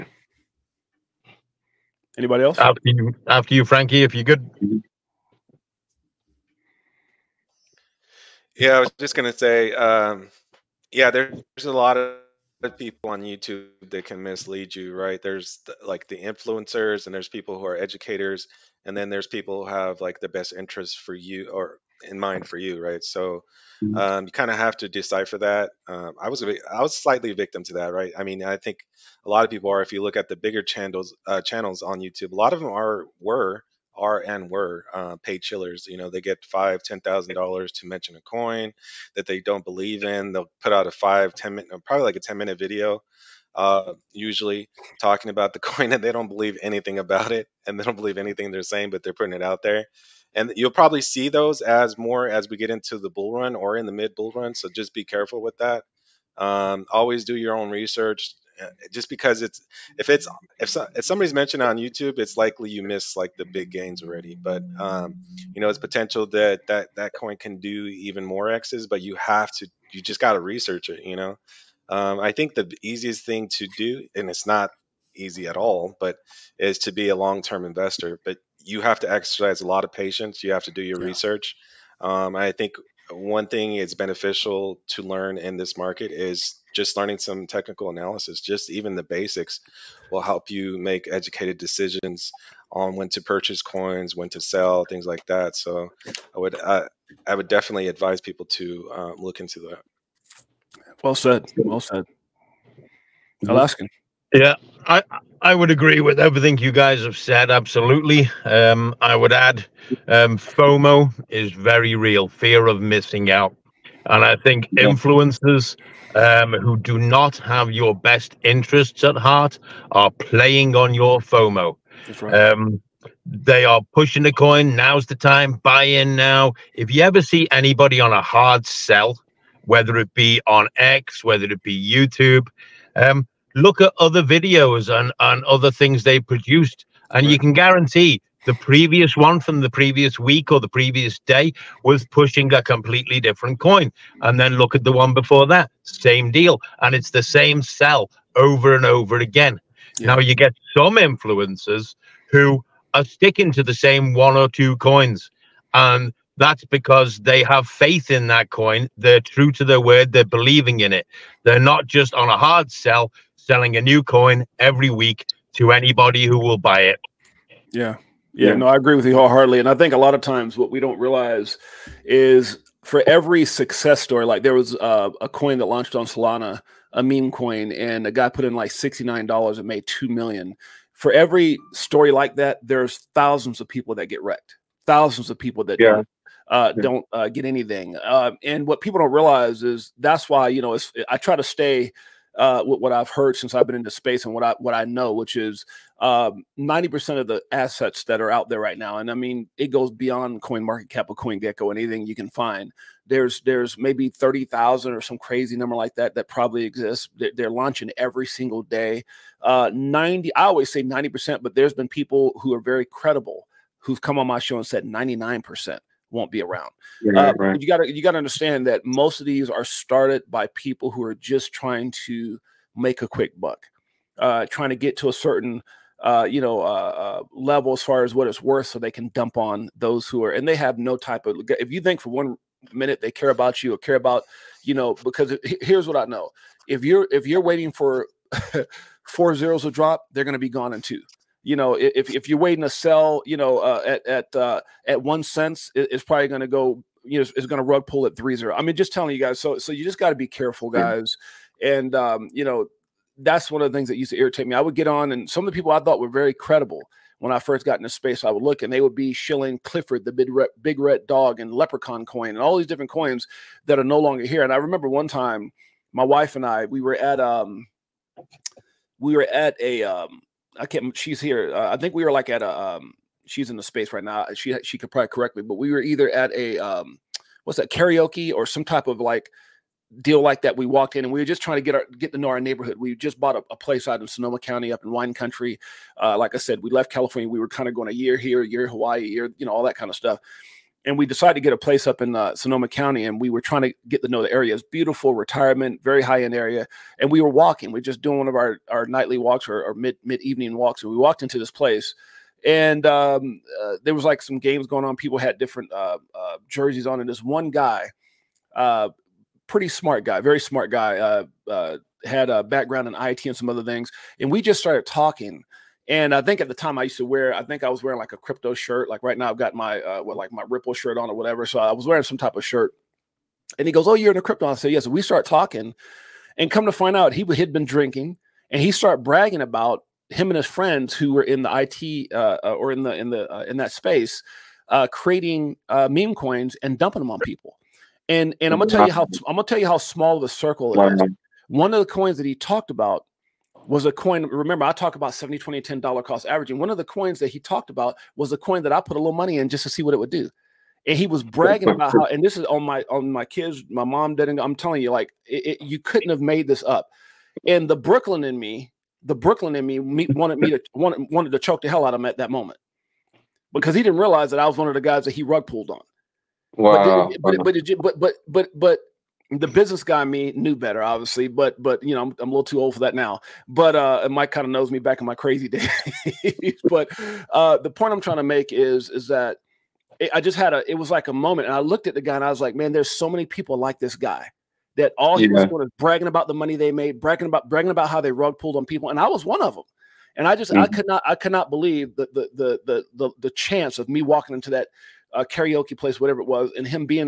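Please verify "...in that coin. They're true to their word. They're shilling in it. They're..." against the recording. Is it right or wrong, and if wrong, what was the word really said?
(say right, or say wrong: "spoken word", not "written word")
wrong: "believing", not "shilling".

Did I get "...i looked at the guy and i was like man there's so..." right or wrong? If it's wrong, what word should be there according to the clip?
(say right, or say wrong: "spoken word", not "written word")
right.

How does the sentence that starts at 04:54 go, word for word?
It's beautiful, retirement, very high end area, and we were walking.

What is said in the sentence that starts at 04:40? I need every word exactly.
We walked in and we were just trying to get our get to know our neighborhood.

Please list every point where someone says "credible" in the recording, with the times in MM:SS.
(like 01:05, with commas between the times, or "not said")
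03:32, 04:16.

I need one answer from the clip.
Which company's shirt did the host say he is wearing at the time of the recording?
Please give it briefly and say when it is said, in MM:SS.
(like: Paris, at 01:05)
Ripple, at 05:20.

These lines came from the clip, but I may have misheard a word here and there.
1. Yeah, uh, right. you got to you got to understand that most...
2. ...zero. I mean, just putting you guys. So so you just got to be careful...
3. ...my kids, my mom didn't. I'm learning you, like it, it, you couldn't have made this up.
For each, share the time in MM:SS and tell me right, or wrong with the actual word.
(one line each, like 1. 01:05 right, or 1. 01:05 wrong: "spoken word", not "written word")
1. 03:37 right
2. 04:08 wrong: "telling", not "putting"
3. 05:53 wrong: "telling", not "learning".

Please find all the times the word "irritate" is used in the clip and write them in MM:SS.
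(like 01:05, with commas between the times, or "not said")
04:14.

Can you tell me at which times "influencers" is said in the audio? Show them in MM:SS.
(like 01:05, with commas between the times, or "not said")
00:16, 01:54, 02:30.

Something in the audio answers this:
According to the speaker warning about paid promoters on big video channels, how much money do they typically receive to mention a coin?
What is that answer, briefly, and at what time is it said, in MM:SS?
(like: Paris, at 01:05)
5,000 to 10,000 dollars, at 00:36.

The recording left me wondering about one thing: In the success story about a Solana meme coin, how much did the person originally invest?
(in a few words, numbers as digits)
$69.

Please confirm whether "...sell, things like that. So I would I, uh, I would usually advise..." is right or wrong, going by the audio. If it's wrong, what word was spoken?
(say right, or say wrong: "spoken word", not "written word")
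wrong: "definitely", not "usually".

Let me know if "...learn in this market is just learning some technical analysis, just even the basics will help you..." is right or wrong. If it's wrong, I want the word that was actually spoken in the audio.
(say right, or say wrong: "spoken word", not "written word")
right.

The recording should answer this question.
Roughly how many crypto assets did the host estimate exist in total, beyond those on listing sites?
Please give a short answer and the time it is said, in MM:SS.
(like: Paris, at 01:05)
30,000, at 03:24.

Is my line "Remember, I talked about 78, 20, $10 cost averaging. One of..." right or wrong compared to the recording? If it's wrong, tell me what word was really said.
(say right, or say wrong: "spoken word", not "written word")
wrong: "70", not "78".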